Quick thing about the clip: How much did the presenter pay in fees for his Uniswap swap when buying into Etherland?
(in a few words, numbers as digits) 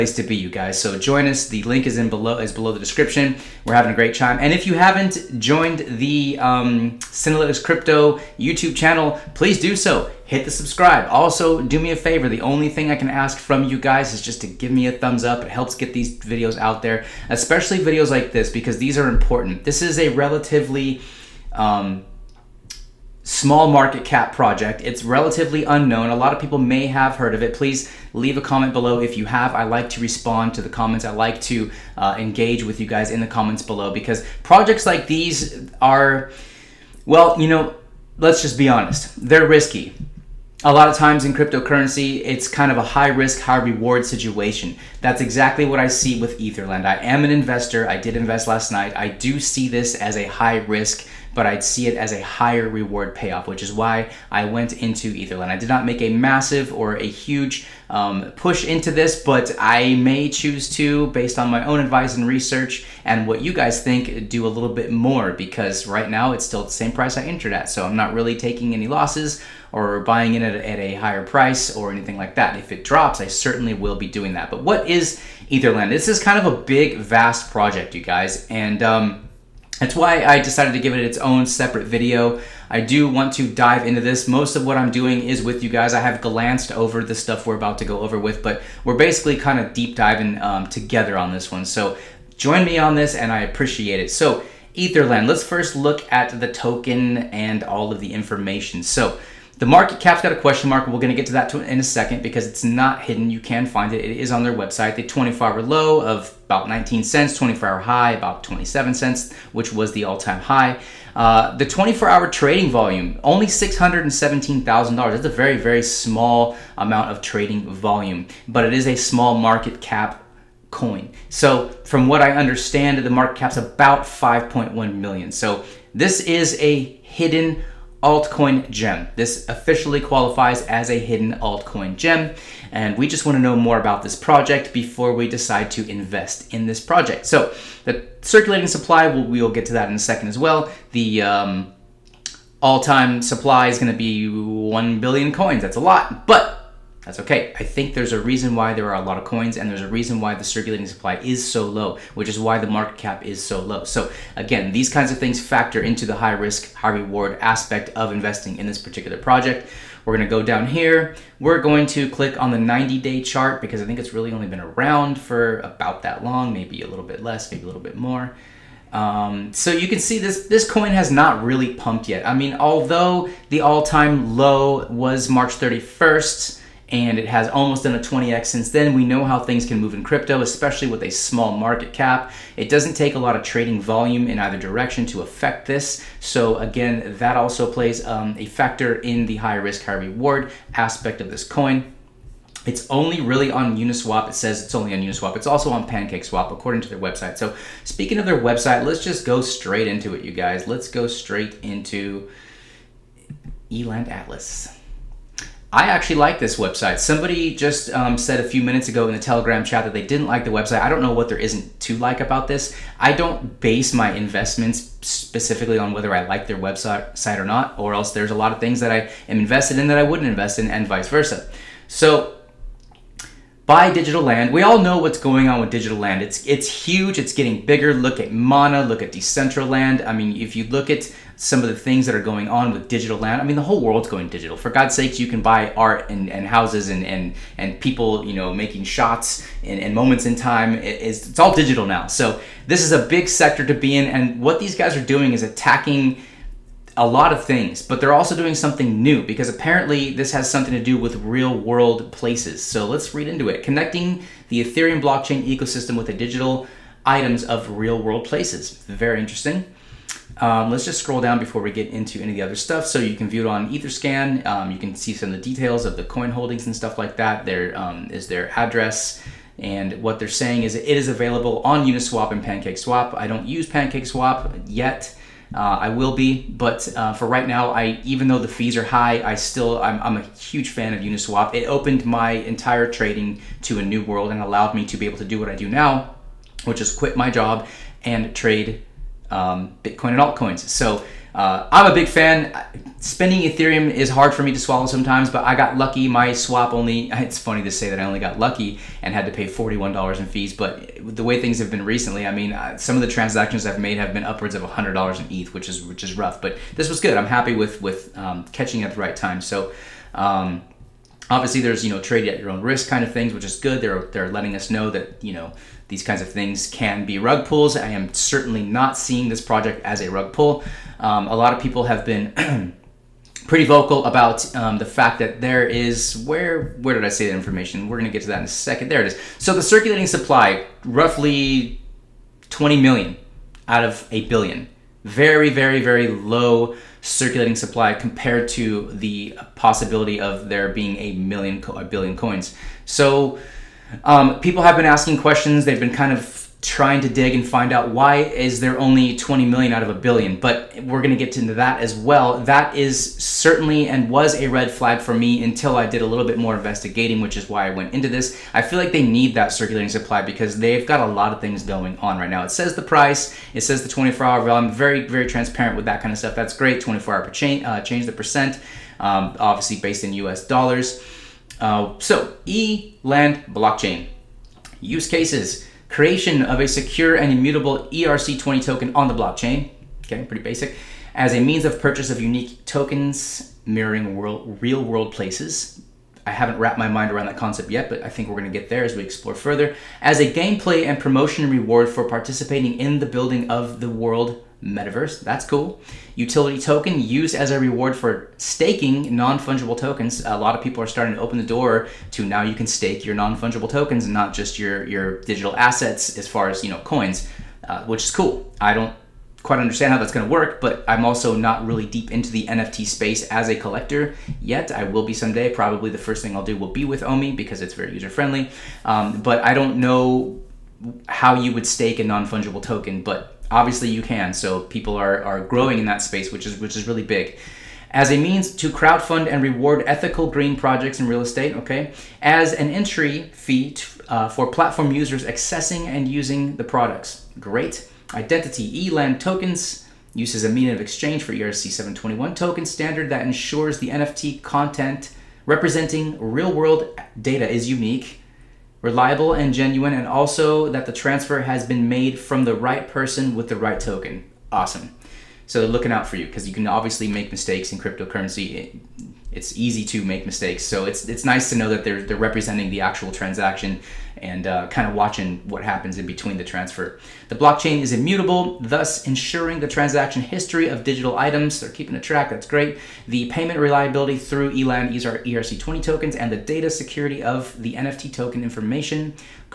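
$41.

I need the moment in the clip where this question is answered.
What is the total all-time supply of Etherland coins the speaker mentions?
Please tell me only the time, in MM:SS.
02:24.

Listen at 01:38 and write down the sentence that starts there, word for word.
So the market cap's got a question mark.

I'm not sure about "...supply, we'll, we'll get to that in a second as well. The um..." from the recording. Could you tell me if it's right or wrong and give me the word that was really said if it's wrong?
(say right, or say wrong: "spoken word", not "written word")
right.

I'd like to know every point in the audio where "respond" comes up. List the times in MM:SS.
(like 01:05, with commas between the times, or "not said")
00:30.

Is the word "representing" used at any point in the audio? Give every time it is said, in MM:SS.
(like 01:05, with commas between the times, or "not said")
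07:25, 07:42.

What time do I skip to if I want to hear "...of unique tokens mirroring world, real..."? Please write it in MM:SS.
06:22.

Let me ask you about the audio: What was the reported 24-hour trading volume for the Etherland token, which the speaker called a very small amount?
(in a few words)
$617,000.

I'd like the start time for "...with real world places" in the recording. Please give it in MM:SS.
04:10.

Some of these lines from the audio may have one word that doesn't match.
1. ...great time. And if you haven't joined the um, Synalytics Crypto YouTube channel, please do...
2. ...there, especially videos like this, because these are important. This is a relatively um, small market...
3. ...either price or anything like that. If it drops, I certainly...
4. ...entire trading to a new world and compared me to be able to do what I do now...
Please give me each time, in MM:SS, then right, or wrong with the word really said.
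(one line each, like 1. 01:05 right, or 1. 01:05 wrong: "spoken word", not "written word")
1. 00:03 right
2. 00:16 right
3. 01:10 wrong: "higher", not "either"
4. 04:42 wrong: "allowed", not "compared".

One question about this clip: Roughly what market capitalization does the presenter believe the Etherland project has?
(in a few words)
5.1 million.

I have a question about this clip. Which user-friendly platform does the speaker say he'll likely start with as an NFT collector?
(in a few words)
Omi.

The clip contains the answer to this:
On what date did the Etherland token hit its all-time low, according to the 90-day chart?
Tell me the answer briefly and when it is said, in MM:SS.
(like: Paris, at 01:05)
March 31st, at 02:55.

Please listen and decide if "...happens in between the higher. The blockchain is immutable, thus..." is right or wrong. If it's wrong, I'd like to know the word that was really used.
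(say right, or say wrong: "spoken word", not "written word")
wrong: "transfer", not "higher".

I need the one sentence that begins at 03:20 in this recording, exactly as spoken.
Let's go straight into Eland Atlas.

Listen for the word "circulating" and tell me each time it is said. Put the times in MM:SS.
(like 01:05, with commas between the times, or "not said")
02:18, 02:30, 05:29, 05:37, 05:59.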